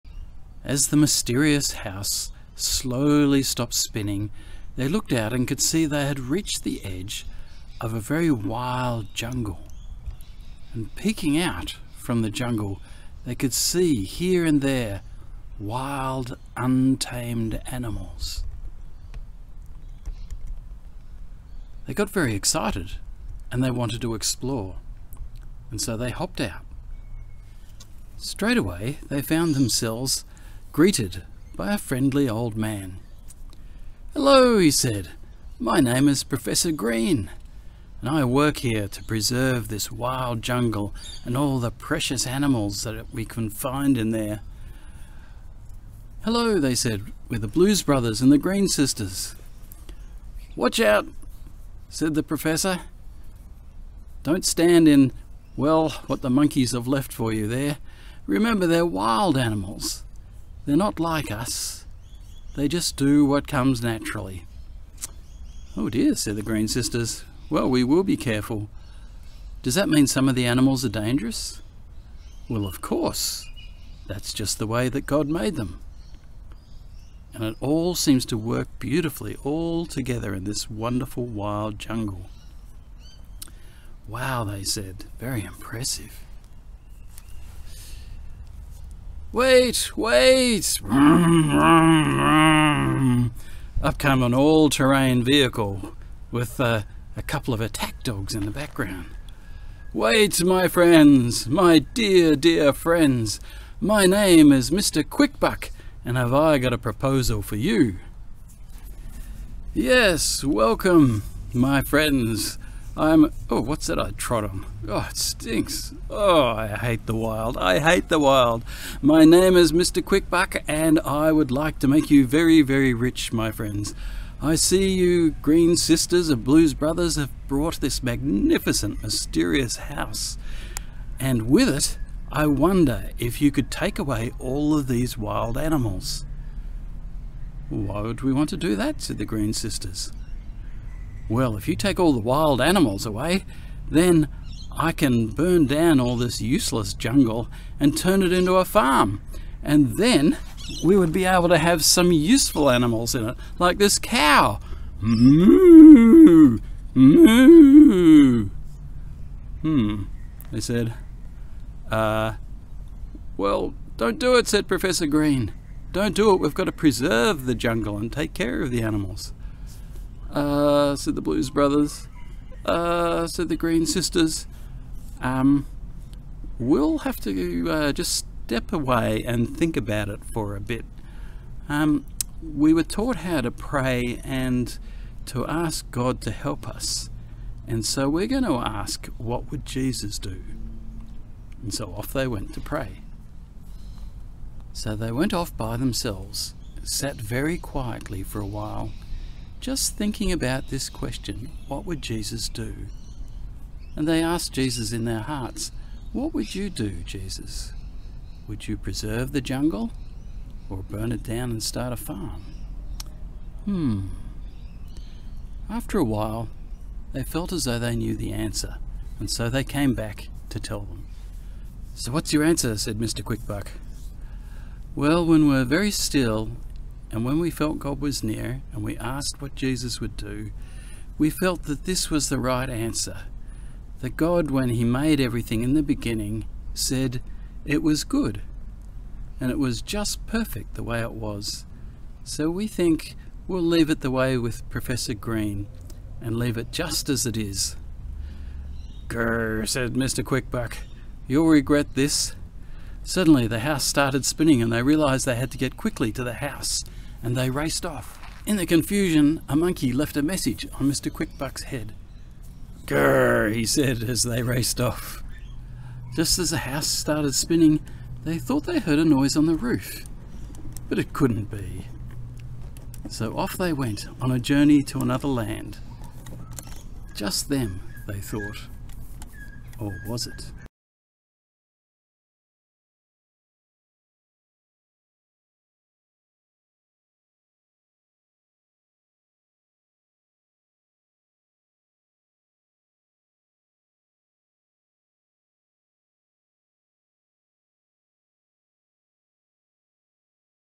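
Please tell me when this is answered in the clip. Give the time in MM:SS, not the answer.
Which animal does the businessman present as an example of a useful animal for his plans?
02:33.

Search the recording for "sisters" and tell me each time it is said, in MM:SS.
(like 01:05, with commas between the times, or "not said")
00:48, 01:06, 02:05, 02:19, 02:53.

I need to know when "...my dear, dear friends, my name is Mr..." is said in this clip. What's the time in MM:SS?
01:41.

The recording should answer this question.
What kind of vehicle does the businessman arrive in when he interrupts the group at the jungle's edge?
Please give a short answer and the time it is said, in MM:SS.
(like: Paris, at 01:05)
all-terrain vehicle, at 01:34.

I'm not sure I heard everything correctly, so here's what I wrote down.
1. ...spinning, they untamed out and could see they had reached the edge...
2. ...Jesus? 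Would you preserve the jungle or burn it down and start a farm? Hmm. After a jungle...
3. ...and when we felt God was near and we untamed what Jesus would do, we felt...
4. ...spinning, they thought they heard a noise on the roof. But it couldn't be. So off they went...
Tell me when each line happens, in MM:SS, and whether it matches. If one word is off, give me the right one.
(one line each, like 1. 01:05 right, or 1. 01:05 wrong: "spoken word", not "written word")
1. 00:03 wrong: "looked", not "untamed"
2. 03:27 wrong: "while", not "jungle"
3. 03:47 wrong: "asked", not "untamed"
4. 04:27 right.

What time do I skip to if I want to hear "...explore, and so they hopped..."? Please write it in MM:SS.
00:24.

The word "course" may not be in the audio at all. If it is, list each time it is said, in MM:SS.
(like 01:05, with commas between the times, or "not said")
01:12.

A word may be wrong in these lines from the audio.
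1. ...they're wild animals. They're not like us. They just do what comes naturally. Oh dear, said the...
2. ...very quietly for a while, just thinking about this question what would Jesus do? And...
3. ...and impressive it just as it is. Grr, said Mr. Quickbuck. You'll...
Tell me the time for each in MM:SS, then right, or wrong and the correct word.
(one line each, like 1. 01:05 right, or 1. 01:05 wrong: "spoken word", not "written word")
1. 00:58 right
2. 03:17 right
3. 04:06 wrong: "leave", not "impressive".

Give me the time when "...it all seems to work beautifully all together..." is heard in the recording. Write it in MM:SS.
01:17.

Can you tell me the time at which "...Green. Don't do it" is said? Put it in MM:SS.
02:45.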